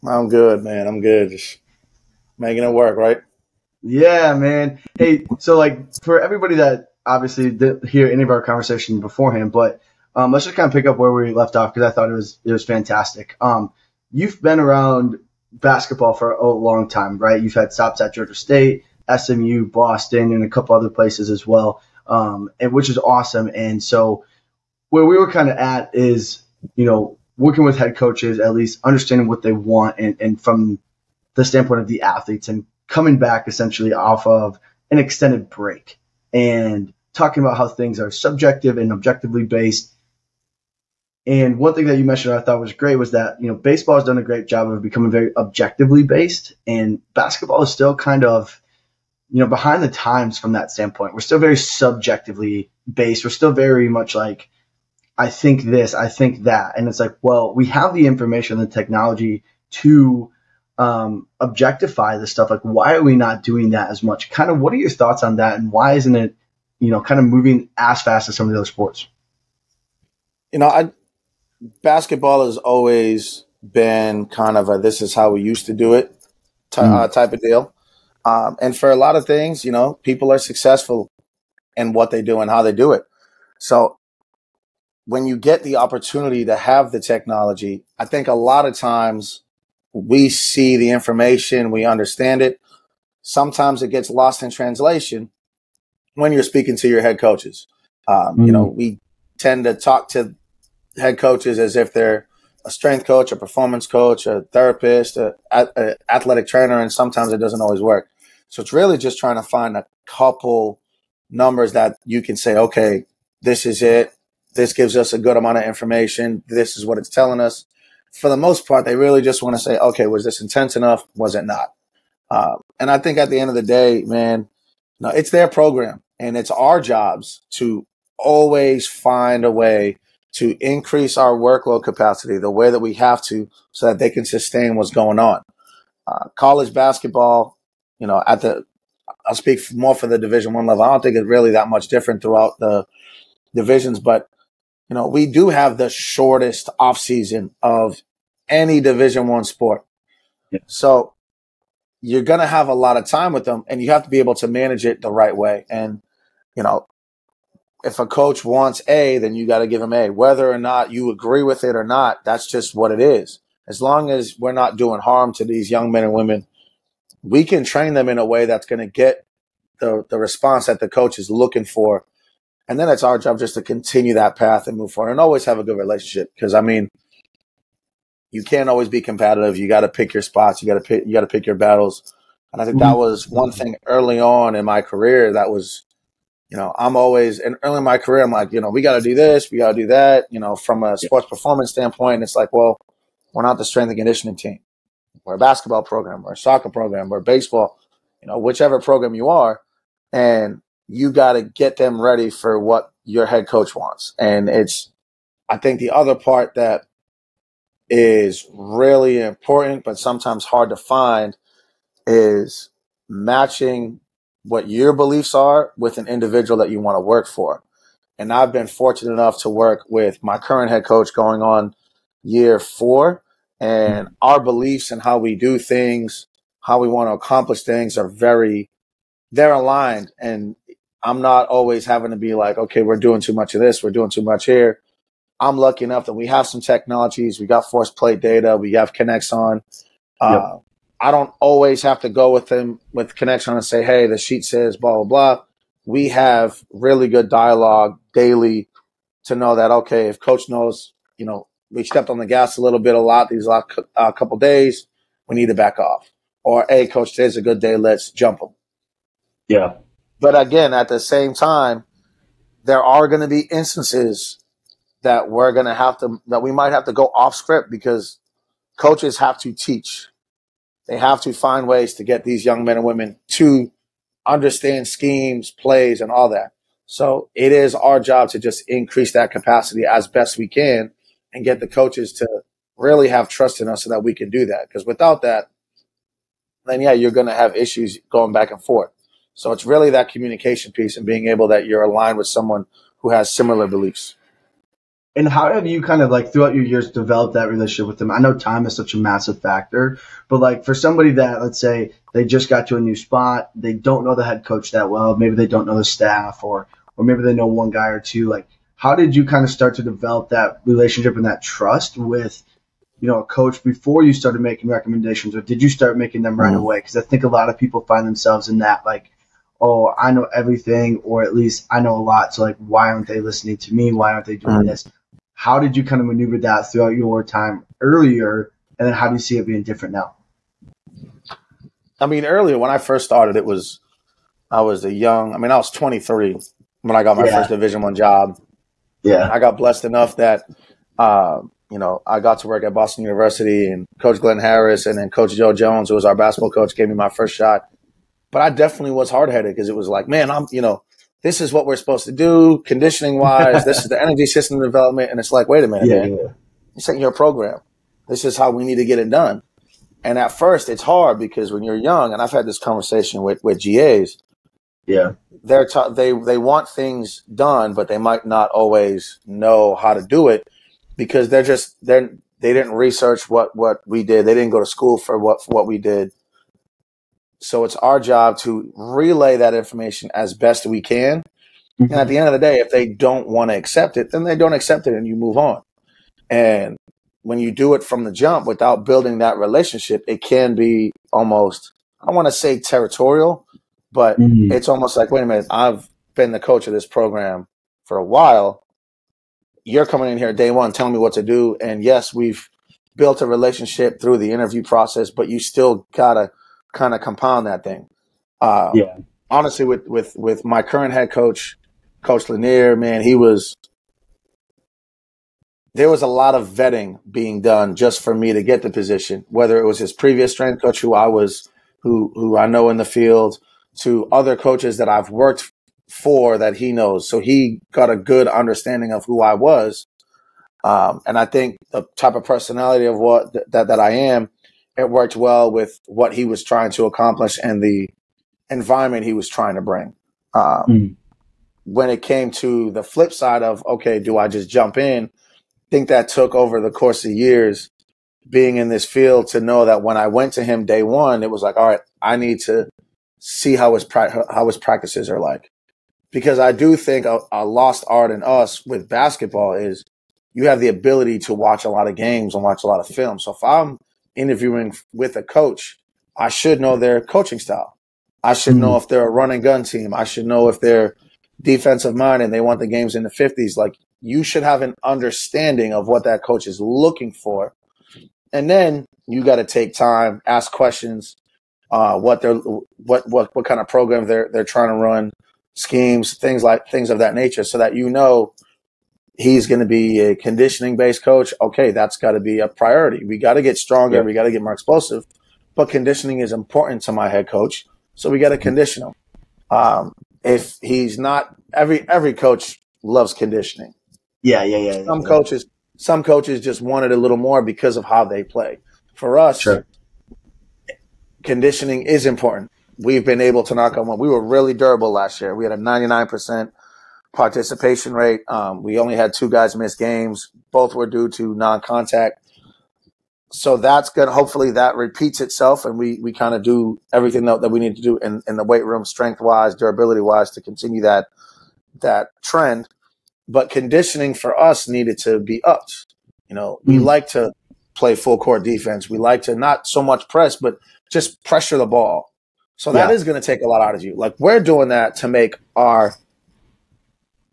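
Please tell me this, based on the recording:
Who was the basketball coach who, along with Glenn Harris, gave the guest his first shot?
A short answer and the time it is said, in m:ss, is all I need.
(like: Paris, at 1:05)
Joe Jones, at 5:45.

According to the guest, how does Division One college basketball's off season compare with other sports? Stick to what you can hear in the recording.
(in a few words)
Shortest off season.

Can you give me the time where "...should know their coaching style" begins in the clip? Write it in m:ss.
7:46.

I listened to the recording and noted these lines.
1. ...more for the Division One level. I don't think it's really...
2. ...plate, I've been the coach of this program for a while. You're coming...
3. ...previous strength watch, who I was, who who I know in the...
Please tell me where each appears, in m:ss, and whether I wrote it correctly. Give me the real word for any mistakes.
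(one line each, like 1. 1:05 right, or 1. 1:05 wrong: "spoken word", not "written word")
1. 2:19 right
2. 6:35 wrong: "minute", not "plate"
3. 6:59 wrong: "coach", not "watch".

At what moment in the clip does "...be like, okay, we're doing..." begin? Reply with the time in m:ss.
3:52.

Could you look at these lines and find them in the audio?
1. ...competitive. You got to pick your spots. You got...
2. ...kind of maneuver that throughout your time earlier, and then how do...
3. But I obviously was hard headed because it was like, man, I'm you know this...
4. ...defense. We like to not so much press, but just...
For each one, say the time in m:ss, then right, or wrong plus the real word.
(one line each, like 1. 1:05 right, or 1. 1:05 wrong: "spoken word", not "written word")
1. 2:59 right
2. 5:25 right
3. 5:48 wrong: "definitely", not "obviously"
4. 8:58 right.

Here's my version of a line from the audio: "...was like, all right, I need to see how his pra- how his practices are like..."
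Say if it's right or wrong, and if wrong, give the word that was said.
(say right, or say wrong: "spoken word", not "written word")
right.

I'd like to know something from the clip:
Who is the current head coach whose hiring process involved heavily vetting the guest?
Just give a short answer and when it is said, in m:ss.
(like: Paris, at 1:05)
Lanier, at 6:52.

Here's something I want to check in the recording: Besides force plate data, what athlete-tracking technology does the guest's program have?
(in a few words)
Kinexon.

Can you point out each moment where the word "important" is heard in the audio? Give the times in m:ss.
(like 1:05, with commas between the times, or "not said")
3:29, 8:16, 8:32.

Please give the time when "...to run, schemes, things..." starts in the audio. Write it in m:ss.
8:04.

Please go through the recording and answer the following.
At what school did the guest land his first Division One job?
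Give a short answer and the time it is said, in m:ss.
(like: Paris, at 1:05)
Boston University, at 5:42.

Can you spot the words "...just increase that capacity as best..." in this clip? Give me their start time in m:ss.
4:38.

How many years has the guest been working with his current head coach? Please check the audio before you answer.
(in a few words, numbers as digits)
4.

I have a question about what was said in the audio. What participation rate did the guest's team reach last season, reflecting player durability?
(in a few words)
99%.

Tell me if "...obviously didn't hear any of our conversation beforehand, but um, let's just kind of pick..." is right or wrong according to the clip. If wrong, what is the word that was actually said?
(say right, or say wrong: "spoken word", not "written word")
right.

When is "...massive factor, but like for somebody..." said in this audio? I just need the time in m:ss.
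4:58.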